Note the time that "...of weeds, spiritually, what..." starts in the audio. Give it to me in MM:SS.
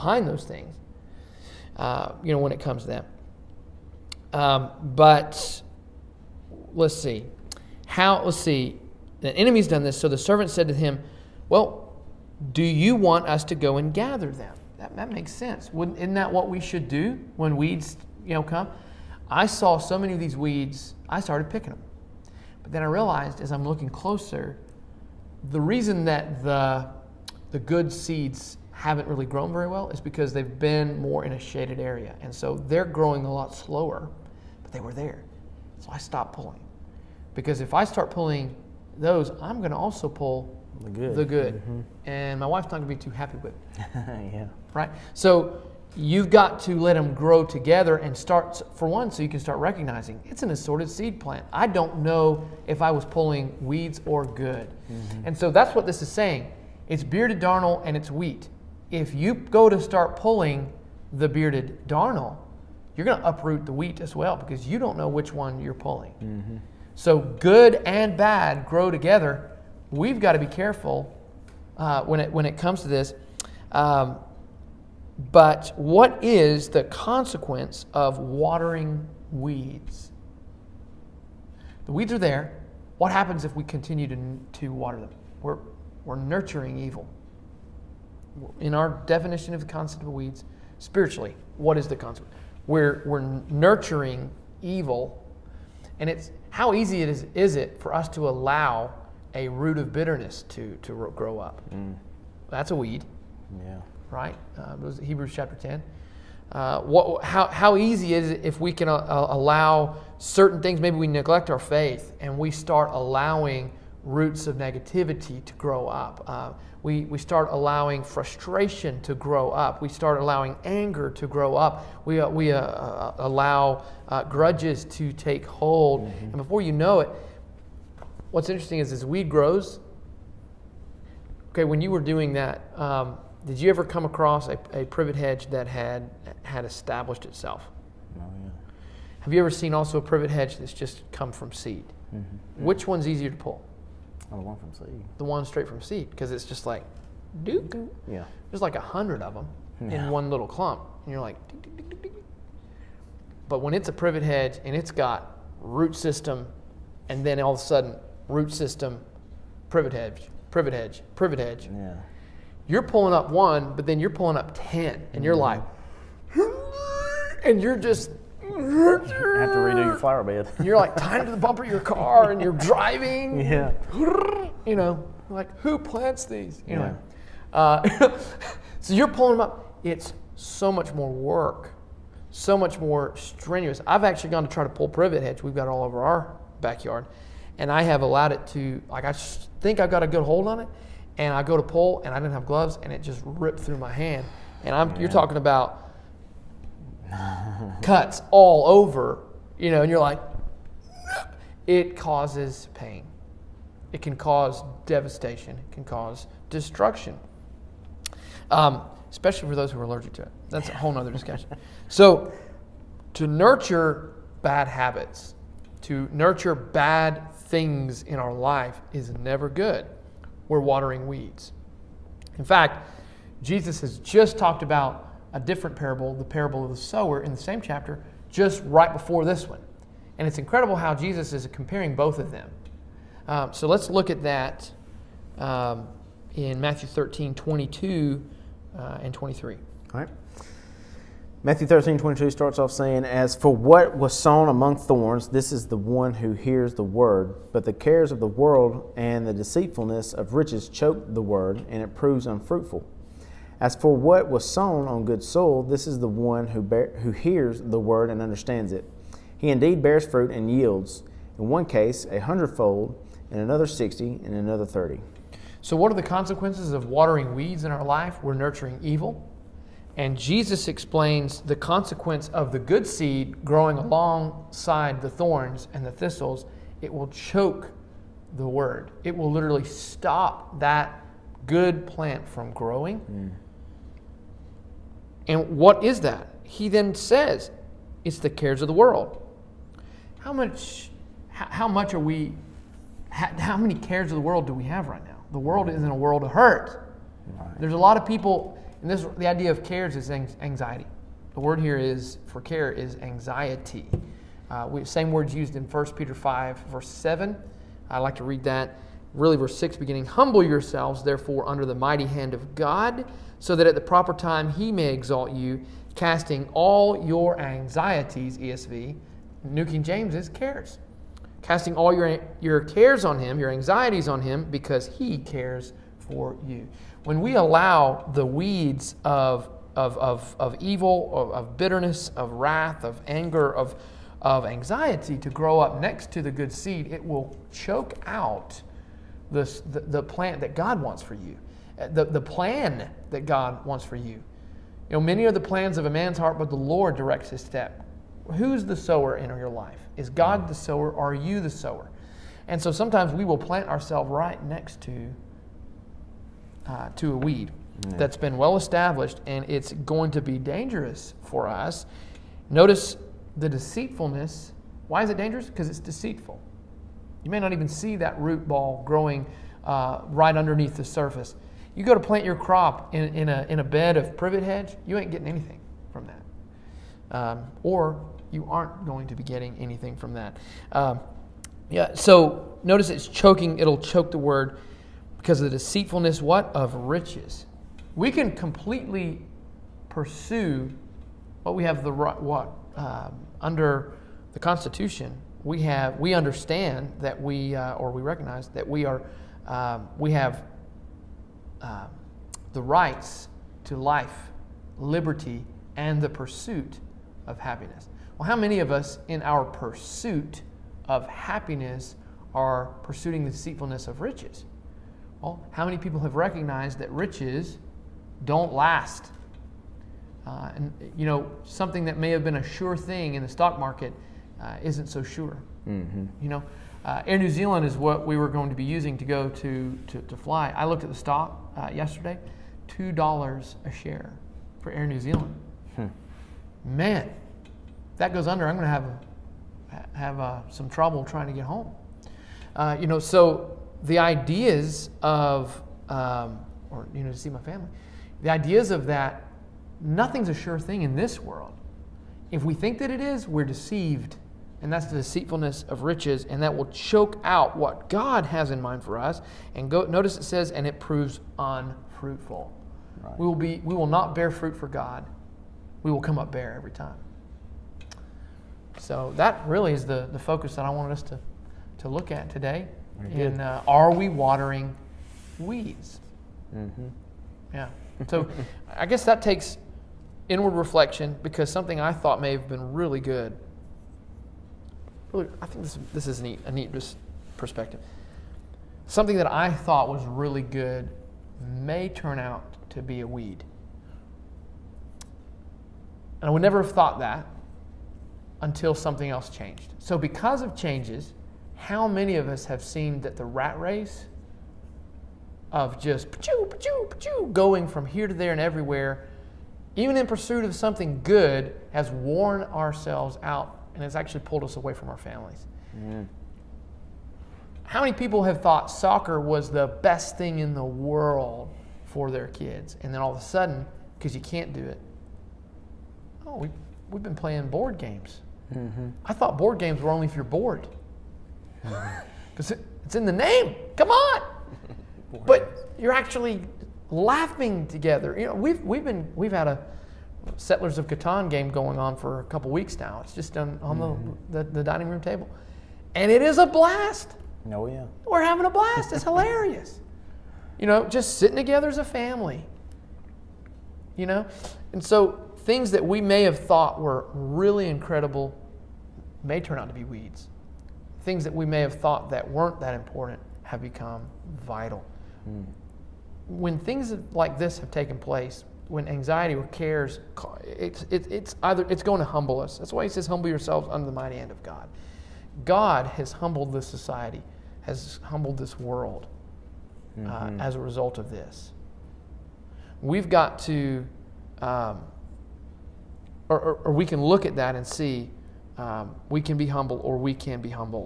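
01:30.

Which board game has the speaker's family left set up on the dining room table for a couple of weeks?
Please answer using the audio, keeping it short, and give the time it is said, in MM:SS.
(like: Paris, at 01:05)
Settlers of Catan, at 09:00.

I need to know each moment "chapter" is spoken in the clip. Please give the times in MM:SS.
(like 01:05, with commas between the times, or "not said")
01:45, 03:47.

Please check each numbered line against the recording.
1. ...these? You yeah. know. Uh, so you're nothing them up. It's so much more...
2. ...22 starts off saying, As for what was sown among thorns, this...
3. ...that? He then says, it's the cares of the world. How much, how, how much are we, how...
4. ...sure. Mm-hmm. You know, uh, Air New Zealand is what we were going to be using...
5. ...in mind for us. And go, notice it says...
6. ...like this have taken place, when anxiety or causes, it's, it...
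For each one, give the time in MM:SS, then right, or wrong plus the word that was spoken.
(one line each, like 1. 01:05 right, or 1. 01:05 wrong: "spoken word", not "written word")
1. 02:56 wrong: "pulling", not "nothing"
2. 04:01 right
3. 04:46 right
4. 07:05 right
5. 07:38 right
6. 09:27 wrong: "cares", not "causes".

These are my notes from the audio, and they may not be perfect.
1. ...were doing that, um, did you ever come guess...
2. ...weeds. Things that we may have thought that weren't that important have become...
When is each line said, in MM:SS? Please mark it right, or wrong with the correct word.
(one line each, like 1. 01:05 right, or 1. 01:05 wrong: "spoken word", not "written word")
1. 02:11 wrong: "across", not "guess"
2. 09:19 right.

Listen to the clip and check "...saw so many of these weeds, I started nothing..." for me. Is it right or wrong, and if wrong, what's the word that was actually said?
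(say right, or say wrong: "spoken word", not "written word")
wrong: "picking", not "nothing".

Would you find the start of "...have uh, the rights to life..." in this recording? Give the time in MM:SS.
06:40.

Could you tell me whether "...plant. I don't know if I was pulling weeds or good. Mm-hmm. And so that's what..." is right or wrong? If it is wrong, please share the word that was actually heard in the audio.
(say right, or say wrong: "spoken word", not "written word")
right.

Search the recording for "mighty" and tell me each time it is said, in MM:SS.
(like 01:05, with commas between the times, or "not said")
05:11, 09:33.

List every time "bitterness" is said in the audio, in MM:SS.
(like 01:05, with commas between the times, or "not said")
01:39, 05:31.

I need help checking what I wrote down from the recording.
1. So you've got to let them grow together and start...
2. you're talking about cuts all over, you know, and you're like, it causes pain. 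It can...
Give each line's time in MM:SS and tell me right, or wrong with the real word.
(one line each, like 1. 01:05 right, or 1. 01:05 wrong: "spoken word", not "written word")
1. 00:45 right
2. 03:14 right.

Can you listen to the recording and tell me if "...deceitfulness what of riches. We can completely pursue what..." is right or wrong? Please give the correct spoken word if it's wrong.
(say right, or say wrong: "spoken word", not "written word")
right.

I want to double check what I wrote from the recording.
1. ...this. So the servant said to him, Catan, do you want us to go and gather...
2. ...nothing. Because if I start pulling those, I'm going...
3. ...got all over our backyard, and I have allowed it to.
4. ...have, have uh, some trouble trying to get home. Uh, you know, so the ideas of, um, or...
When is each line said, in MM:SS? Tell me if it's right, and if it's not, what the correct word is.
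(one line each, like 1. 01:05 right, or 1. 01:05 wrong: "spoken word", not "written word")
1. 00:09 wrong: "Well", not "Catan"
2. 00:36 wrong: "pulling", not "nothing"
3. 03:05 right
4. 07:18 right.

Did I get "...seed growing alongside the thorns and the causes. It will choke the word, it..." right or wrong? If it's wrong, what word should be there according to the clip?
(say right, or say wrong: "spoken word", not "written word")
wrong: "thistles", not "causes".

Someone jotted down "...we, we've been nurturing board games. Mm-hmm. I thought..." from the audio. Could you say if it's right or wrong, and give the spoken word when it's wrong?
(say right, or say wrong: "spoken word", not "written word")
wrong: "playing", not "nurturing".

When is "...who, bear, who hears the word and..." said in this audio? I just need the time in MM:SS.
04:16.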